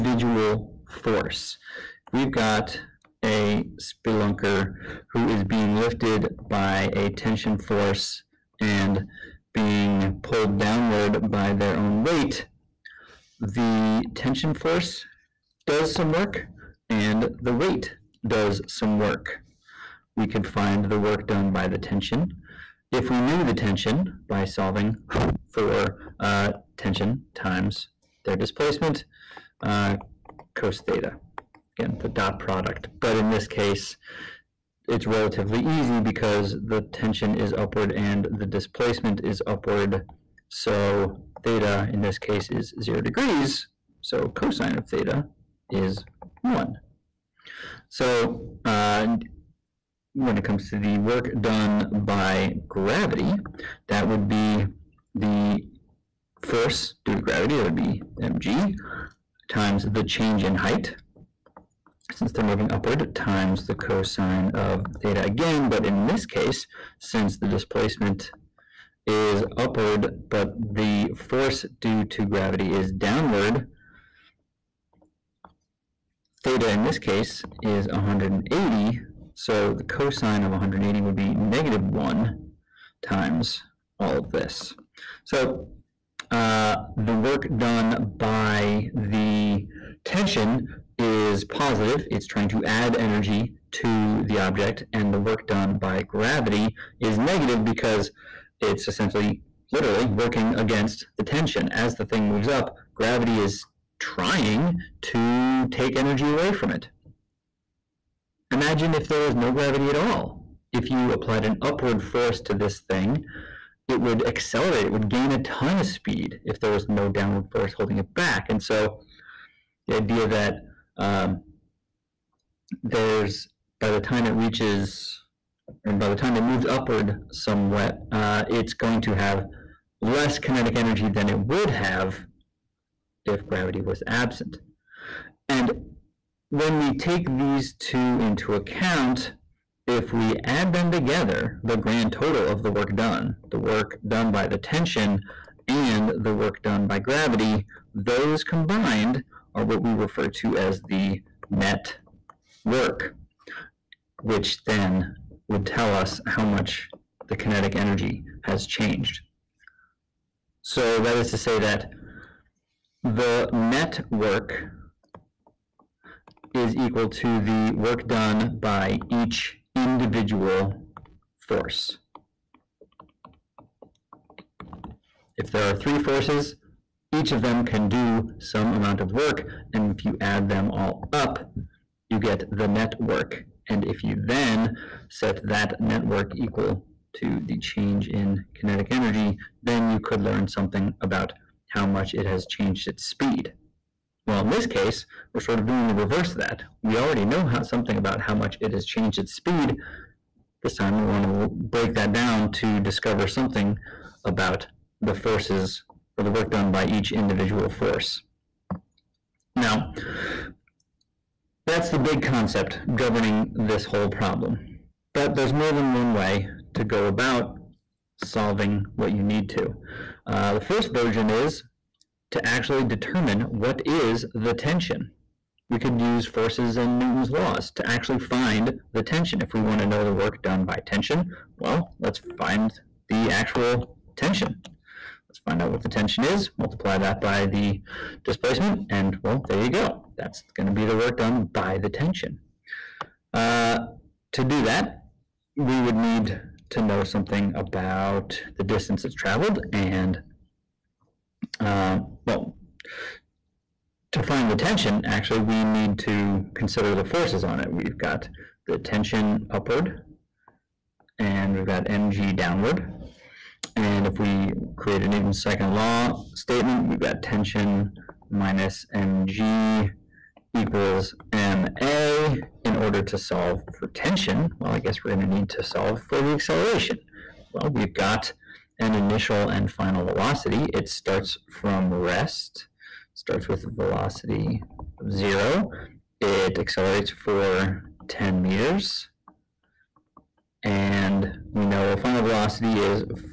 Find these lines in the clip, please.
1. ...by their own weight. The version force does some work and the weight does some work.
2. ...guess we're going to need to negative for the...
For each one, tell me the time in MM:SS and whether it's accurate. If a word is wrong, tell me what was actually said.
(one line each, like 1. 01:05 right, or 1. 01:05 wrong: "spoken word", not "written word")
1. 00:11 wrong: "tension", not "version"
2. 04:34 wrong: "solve", not "negative".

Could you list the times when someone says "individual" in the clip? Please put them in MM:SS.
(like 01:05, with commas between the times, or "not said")
02:49, 03:27.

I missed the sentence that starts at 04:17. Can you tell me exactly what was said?
We've got the tension upward, and we've got mg downward.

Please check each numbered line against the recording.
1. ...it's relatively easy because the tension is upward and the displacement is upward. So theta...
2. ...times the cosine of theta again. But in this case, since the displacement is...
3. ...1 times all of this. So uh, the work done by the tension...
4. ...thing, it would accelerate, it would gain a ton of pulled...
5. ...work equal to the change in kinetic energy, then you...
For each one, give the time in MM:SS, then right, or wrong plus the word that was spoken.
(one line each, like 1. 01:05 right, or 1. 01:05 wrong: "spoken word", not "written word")
1. 00:34 right
2. 01:03 right
3. 01:21 right
4. 01:52 wrong: "speed", not "pulled"
5. 03:06 right.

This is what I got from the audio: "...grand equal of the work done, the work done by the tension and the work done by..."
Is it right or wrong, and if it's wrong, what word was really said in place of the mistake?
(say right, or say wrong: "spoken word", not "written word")
wrong: "total", not "equal".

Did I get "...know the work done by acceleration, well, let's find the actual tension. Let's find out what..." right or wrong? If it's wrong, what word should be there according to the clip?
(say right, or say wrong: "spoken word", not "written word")
wrong: "tension", not "acceleration".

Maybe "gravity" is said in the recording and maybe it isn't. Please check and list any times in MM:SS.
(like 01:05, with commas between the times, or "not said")
00:52, 00:57, 01:12, 01:36, 01:42, 01:49, 02:13, 02:26.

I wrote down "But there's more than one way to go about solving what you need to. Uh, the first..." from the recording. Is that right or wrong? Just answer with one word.
right.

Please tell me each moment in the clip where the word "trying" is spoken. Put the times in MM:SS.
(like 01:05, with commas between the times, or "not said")
01:32, 01:43.